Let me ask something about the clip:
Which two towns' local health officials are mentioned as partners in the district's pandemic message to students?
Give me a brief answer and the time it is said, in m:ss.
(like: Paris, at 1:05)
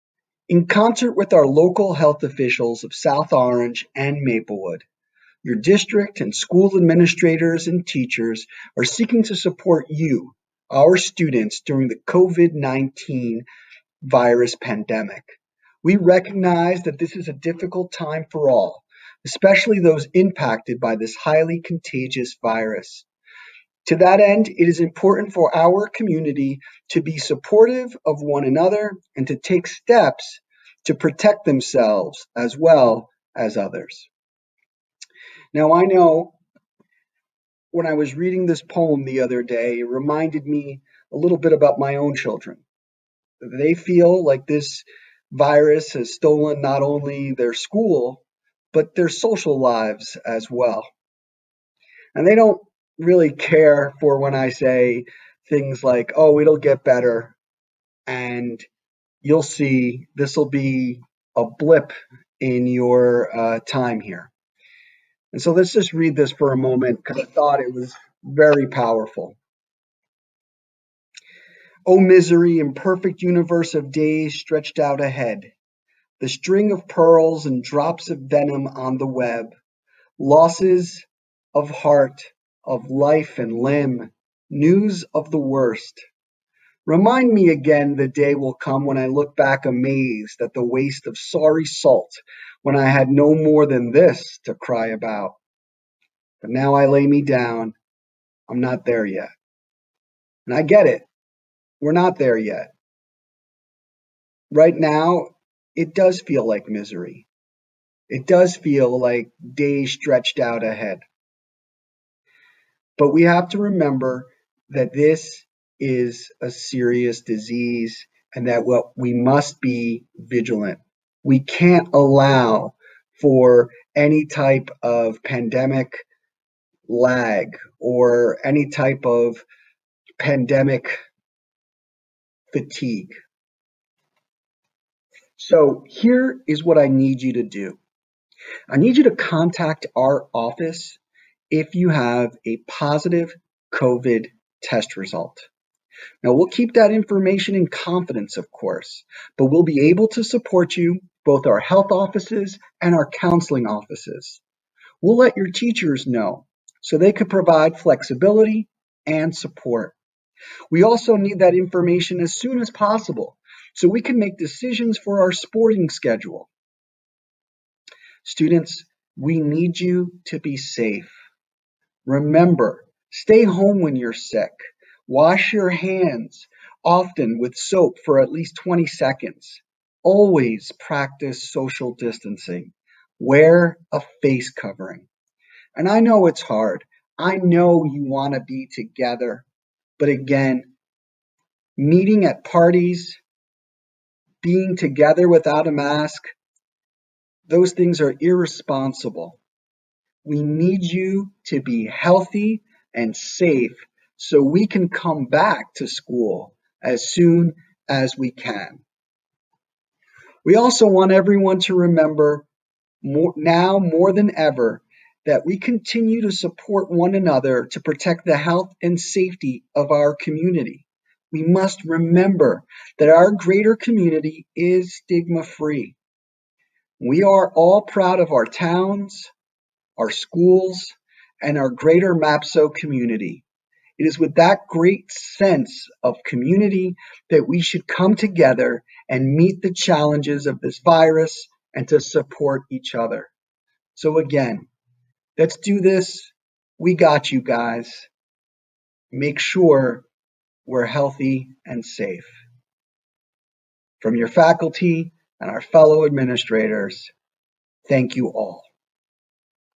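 South Orange and Maplewood, at 0:02.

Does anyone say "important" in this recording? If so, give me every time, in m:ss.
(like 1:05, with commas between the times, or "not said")
0:24.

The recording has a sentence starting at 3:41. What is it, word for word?
We must remember that our greater community is stigma free.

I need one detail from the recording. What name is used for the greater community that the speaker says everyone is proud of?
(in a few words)
MAPSO.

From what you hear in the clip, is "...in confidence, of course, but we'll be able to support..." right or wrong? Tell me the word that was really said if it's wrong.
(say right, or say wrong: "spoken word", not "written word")
right.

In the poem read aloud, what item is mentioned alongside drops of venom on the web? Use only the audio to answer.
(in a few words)
string of pearls.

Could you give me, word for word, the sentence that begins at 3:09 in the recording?
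But again, meeting at parties, being together without a mask, those things are irresponsible.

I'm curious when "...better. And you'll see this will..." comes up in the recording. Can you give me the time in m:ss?
0:56.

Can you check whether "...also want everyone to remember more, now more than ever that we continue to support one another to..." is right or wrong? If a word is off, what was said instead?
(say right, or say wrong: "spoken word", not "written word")
right.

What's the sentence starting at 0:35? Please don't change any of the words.
Now, I know when I was reading this poem the other day, it reminded me a little bit about my own children.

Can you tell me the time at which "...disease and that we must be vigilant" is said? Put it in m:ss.
1:57.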